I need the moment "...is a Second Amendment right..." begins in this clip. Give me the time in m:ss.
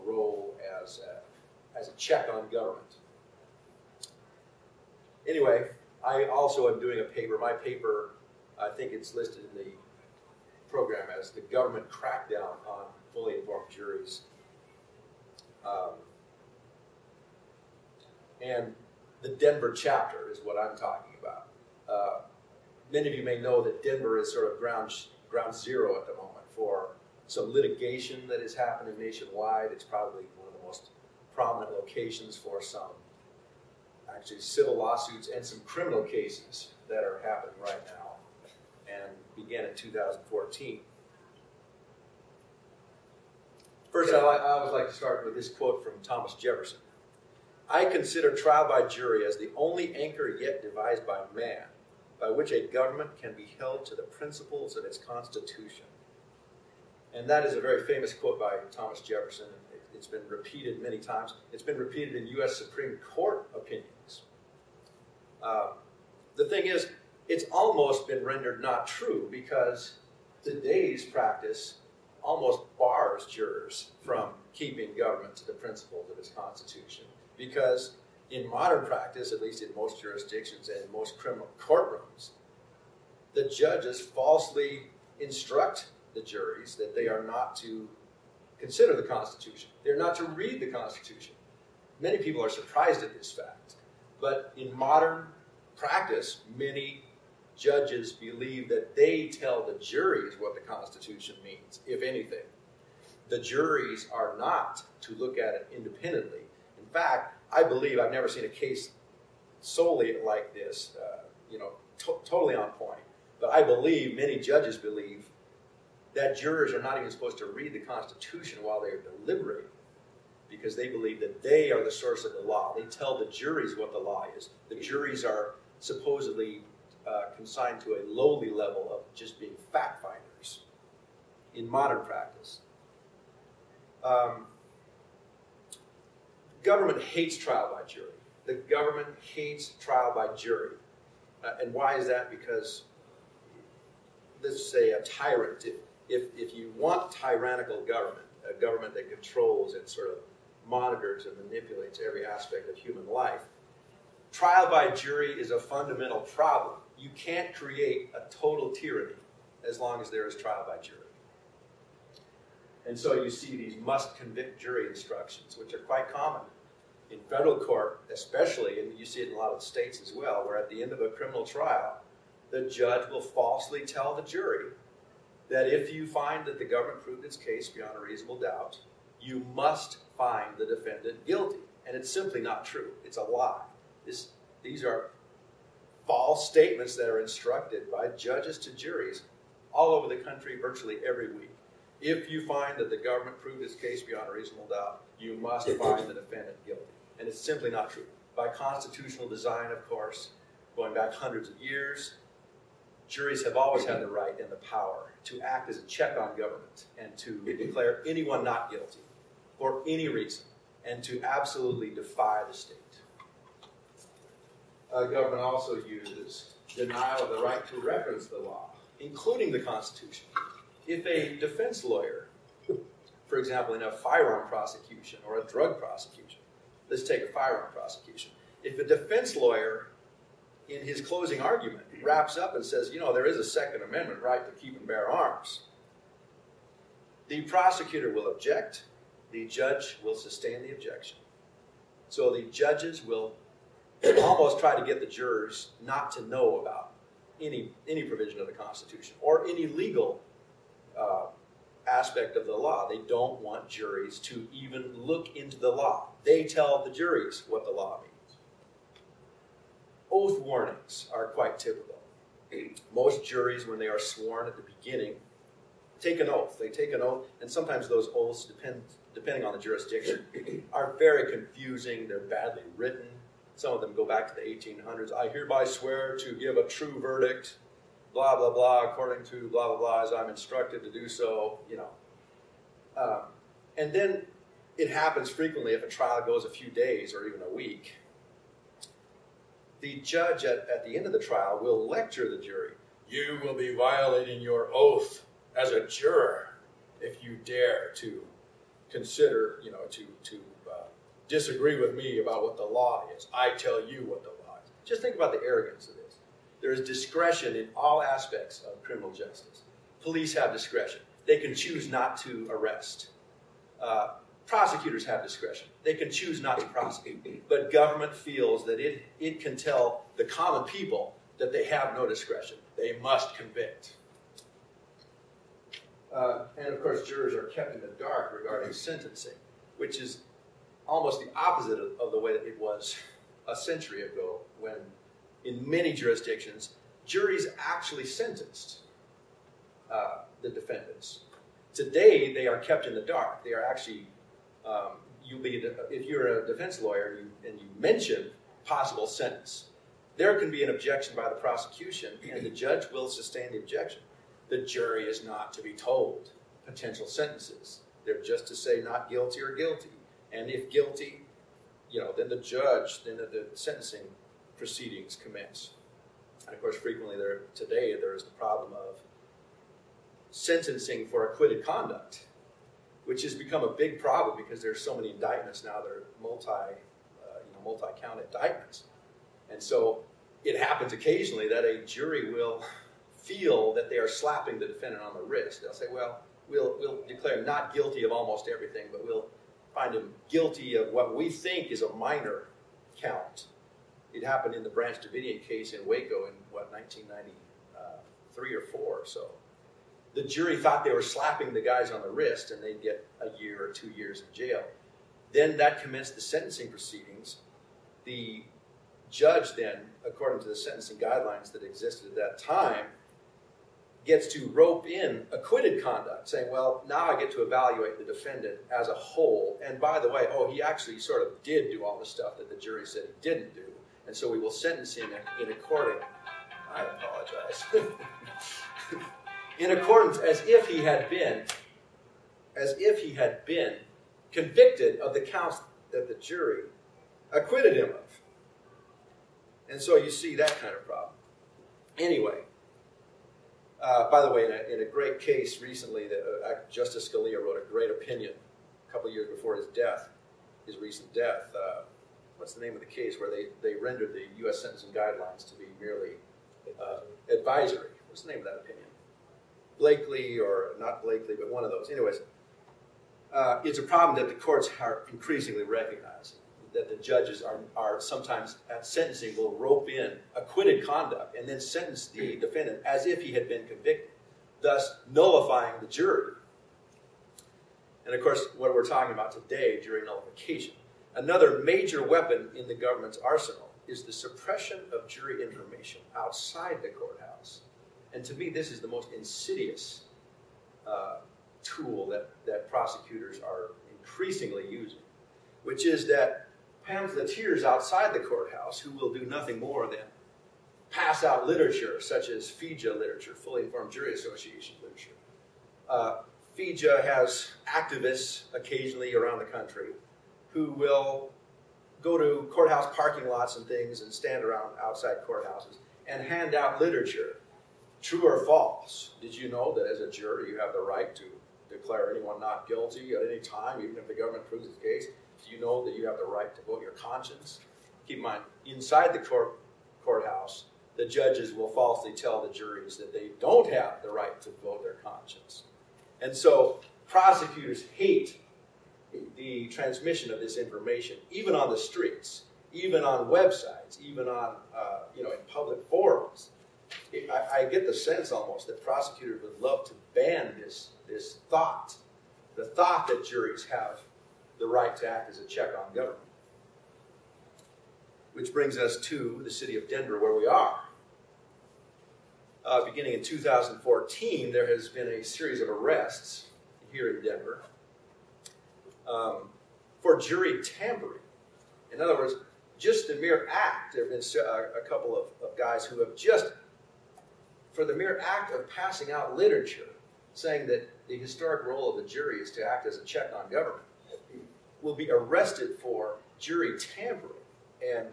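3:53.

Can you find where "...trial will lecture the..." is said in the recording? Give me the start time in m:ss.
4:51.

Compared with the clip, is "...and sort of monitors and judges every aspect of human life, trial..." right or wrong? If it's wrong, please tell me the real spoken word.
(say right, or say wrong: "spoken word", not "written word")
wrong: "manipulates", not "judges".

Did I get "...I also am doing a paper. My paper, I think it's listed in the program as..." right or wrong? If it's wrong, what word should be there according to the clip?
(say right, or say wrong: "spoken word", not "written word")
right.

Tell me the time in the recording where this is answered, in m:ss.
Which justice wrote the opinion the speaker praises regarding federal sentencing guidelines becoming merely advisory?
7:26.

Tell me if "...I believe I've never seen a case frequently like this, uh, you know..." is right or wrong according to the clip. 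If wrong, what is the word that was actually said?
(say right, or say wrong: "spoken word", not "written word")
wrong: "solely", not "frequently".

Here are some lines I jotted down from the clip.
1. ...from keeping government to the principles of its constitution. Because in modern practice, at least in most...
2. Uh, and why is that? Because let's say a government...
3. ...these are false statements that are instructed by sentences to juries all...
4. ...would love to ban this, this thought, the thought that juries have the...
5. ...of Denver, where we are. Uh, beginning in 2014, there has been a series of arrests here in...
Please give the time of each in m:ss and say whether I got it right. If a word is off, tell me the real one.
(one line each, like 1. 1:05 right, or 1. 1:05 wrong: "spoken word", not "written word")
1. 1:14 right
2. 2:21 wrong: "tyrant", not "government"
3. 3:04 wrong: "judges", not "sentences"
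4. 9:09 right
5. 9:19 right.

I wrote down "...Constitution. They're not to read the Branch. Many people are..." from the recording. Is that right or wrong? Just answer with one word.
wrong.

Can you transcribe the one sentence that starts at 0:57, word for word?
And that is a very famous quote by Thomas Jefferson.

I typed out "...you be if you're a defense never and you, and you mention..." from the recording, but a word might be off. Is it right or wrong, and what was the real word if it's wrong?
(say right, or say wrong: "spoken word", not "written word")
wrong: "lawyer", not "never".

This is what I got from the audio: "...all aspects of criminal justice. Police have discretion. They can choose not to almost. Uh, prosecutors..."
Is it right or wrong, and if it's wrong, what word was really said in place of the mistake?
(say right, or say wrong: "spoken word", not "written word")
wrong: "arrest", not "almost".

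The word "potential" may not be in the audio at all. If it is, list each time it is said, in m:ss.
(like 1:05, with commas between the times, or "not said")
5:56.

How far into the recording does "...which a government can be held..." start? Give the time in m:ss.
0:52.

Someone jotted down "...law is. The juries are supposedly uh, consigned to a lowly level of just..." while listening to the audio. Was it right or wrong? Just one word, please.
right.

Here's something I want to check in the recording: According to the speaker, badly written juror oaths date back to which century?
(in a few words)
1800s.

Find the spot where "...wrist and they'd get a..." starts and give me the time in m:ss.
6:42.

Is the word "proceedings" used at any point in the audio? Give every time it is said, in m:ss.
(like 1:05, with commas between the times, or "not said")
6:04, 6:46.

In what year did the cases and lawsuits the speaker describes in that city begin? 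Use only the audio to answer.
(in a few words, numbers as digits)
2014.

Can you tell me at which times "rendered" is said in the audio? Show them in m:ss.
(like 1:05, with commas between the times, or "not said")
1:08, 7:33.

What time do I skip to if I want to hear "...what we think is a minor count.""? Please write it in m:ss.
6:30.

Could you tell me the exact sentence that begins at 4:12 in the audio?
They don't want juries to even look into the law.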